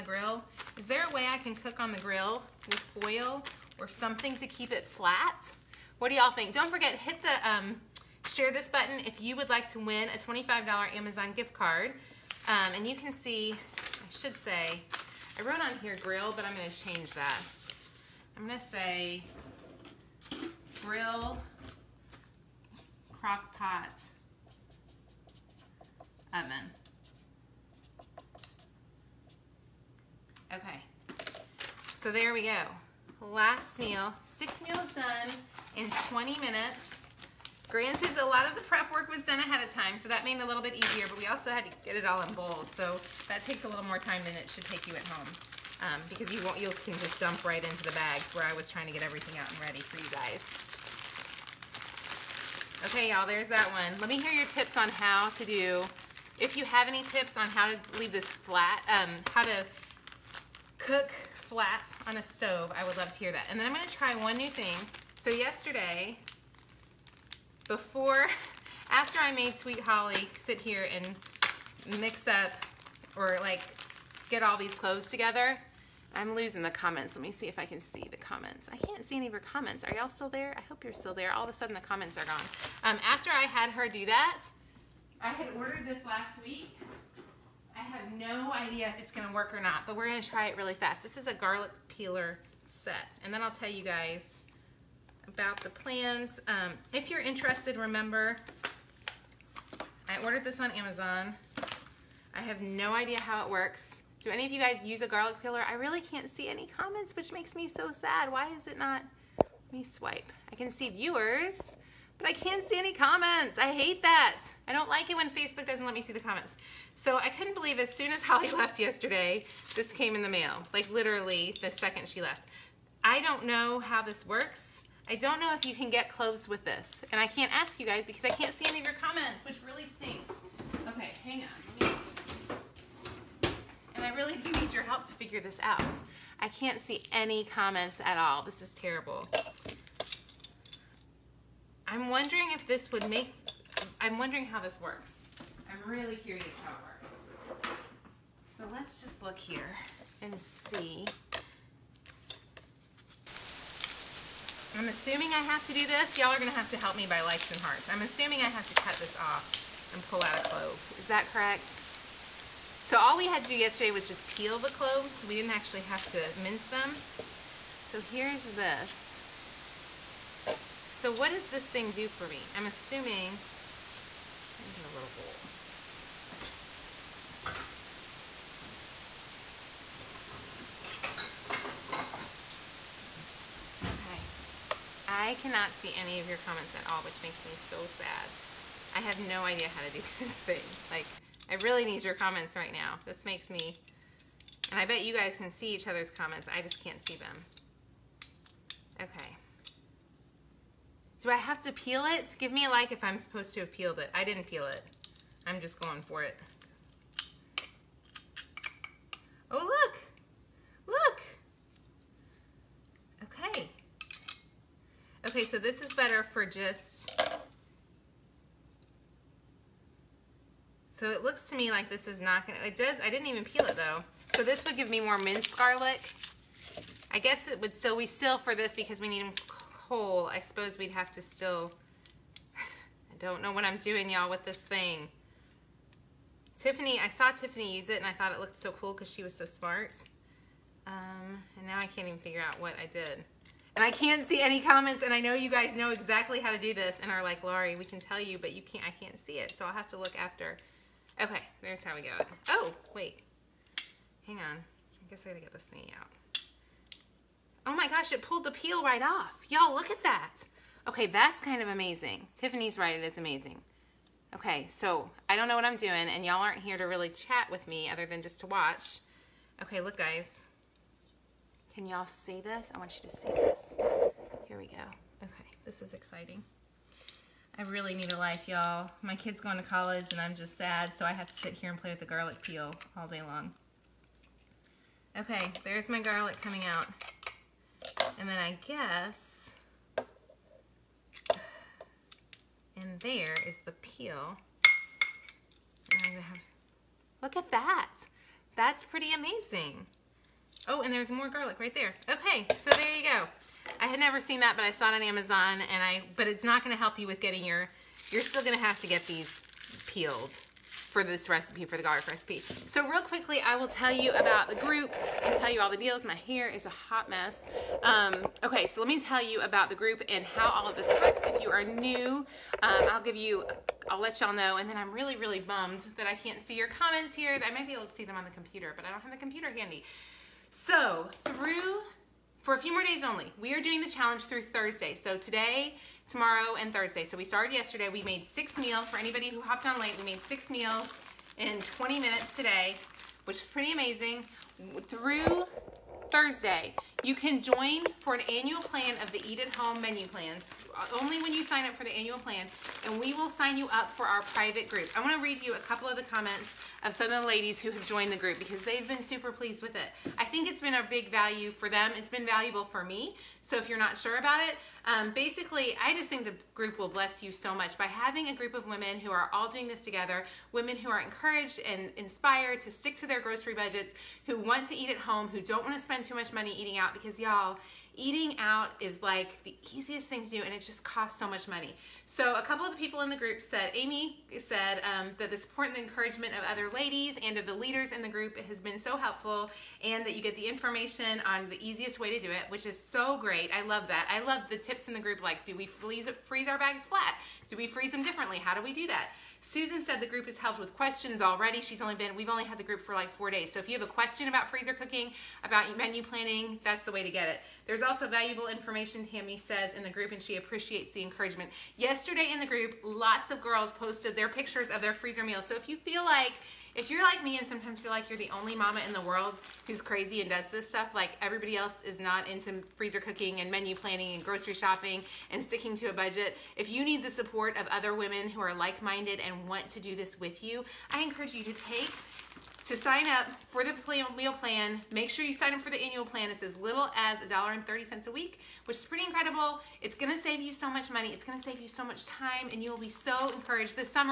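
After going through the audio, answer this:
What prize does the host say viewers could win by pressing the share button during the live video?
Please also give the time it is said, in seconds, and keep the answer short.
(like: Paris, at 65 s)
$25 Amazon gift card, at 10 s.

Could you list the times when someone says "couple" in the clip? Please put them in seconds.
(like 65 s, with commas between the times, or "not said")
355 s, 382 s.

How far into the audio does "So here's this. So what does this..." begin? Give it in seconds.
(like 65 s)
167 s.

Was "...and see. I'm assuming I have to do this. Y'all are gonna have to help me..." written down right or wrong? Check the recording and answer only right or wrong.
right.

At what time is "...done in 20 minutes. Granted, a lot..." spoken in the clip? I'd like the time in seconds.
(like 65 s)
34 s.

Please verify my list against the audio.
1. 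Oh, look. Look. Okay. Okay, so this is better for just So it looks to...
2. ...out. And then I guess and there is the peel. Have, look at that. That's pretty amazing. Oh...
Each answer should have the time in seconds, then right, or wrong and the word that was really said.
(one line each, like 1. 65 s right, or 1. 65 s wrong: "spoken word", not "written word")
1. 209 s right
2. 286 s right.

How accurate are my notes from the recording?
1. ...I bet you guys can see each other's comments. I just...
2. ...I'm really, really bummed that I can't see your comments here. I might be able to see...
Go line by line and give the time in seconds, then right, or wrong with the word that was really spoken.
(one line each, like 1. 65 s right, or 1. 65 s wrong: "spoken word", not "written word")
1. 194 s right
2. 324 s right.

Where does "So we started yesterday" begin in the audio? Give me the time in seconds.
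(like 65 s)
337 s.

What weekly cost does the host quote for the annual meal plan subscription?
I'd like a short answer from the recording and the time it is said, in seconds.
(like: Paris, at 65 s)
$1.30, at 437 s.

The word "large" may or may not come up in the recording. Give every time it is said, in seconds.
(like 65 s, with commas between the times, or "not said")
not said.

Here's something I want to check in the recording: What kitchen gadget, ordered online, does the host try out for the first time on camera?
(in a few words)
garlic peeler set.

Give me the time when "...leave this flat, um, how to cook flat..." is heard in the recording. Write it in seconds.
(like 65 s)
57 s.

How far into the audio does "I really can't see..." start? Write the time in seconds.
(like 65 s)
105 s.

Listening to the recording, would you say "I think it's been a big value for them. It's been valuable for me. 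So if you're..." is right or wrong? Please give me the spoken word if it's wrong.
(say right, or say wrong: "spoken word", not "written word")
right.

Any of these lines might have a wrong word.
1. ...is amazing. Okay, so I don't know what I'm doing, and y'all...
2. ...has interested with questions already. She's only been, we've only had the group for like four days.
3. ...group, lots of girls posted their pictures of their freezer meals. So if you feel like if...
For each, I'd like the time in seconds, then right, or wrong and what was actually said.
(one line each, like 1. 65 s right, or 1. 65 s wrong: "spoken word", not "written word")
1. 263 s right
2. 400 s wrong: "helped", not "interested"
3. 412 s right.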